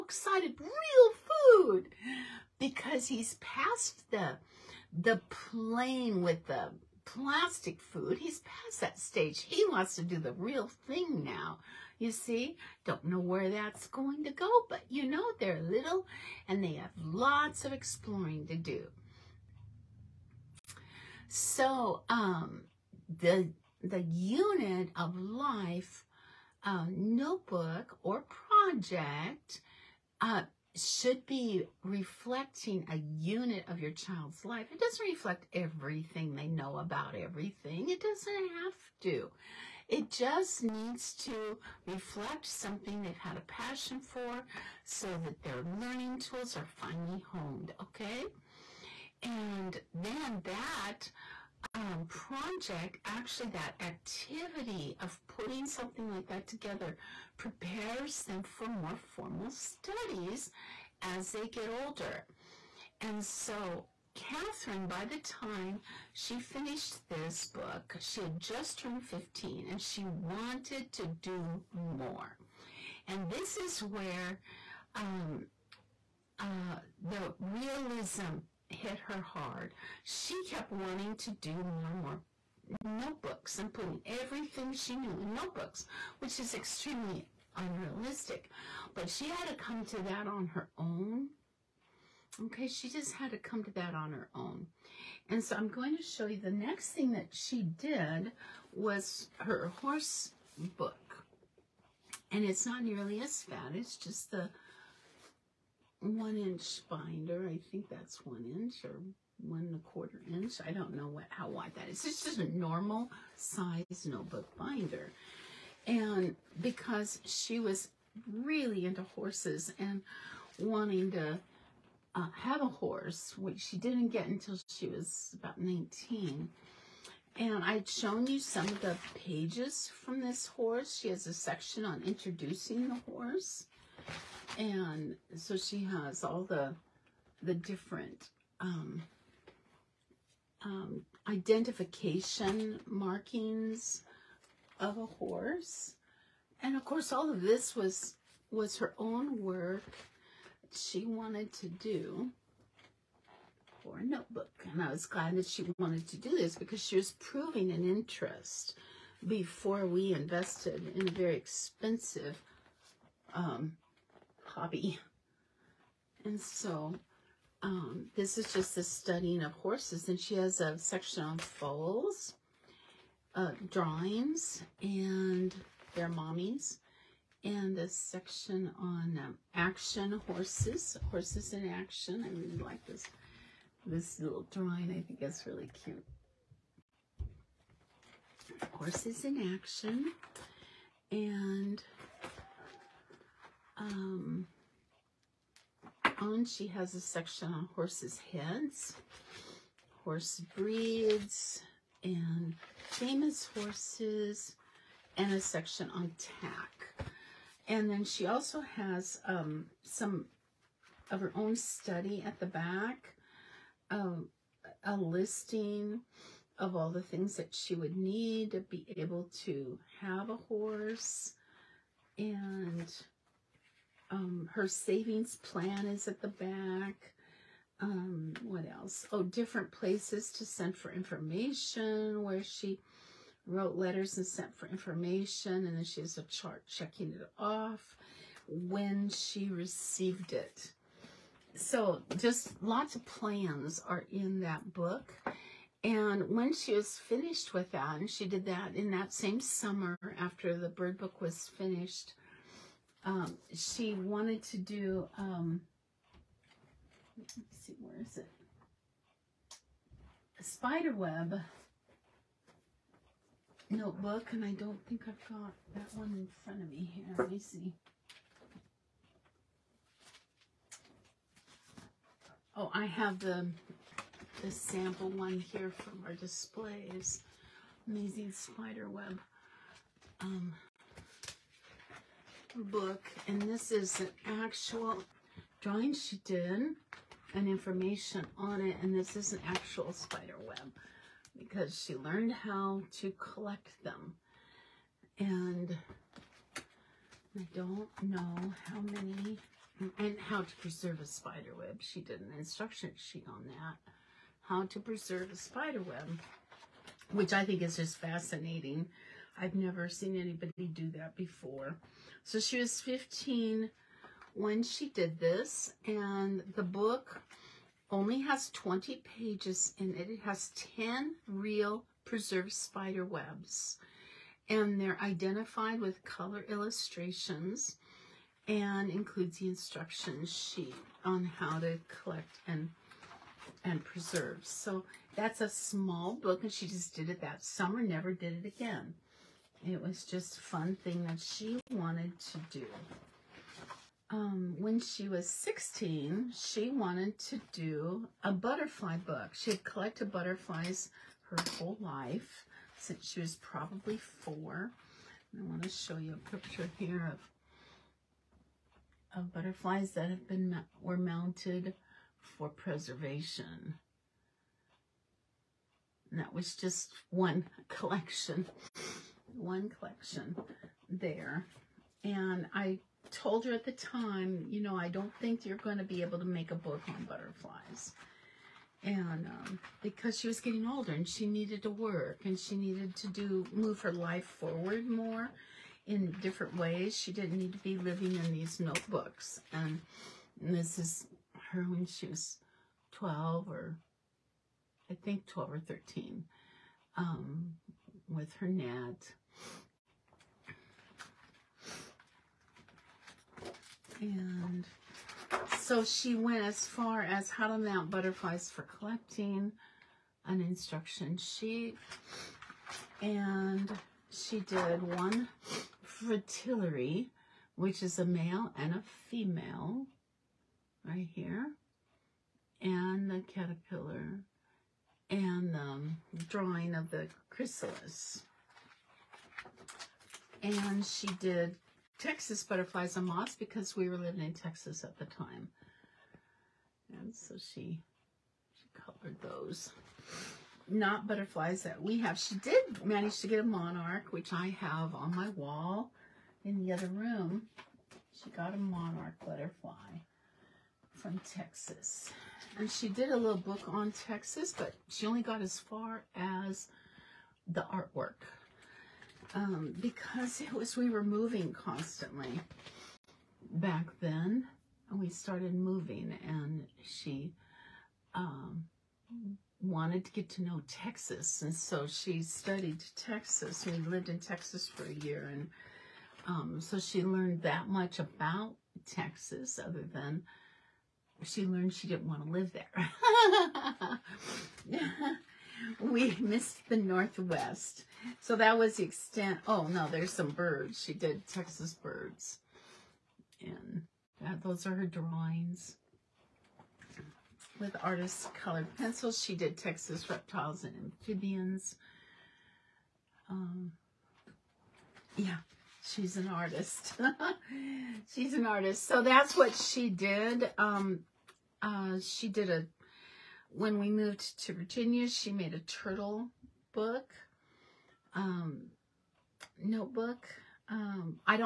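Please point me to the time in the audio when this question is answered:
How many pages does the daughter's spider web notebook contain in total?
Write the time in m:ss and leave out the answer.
5:18.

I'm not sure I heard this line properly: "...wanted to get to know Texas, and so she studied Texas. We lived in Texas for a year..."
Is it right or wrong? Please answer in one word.
right.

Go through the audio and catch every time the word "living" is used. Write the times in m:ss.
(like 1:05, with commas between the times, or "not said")
6:27, 7:13.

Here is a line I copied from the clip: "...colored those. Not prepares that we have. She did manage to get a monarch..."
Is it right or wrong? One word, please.
wrong.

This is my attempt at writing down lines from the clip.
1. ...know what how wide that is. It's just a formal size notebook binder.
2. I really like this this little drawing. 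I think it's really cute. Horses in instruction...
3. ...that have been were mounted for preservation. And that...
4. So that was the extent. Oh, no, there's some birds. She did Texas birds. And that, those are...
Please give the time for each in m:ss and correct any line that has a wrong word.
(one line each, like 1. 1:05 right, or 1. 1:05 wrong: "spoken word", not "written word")
1. 1:50 wrong: "normal", not "formal"
2. 3:02 wrong: "action", not "instruction"
3. 5:59 right
4. 8:08 right.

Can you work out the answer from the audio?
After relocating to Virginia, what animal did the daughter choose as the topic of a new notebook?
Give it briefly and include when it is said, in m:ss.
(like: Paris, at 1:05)
Turtle, at 8:35.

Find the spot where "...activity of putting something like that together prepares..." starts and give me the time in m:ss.
0:53.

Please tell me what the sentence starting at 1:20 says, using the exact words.
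She kept wanting to do more and more notebooks and putting everything she knew in notebooks, which is extremely unrealistic.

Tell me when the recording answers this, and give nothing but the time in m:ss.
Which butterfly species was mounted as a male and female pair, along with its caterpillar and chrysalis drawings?
6:55.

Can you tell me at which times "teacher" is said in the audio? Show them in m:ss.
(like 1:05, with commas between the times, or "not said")
not said.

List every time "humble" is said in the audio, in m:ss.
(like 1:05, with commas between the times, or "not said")
not said.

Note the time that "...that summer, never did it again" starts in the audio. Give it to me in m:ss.
5:37.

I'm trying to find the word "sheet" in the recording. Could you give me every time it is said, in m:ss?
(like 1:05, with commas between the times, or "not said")
5:02, 5:30, 6:51.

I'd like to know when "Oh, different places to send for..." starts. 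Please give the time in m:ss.
3:49.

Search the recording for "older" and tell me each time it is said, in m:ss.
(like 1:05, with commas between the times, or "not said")
1:01, 6:20.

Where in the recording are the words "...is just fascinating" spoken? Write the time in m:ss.
5:07.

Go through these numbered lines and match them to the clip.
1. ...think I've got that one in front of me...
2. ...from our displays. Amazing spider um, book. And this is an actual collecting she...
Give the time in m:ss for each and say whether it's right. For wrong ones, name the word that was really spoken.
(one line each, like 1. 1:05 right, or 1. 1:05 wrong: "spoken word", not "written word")
1. 4:24 right
2. 4:35 wrong: "drawing", not "collecting".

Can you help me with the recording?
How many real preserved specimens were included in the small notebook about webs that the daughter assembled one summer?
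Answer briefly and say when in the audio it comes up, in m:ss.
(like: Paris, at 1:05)
10, at 5:20.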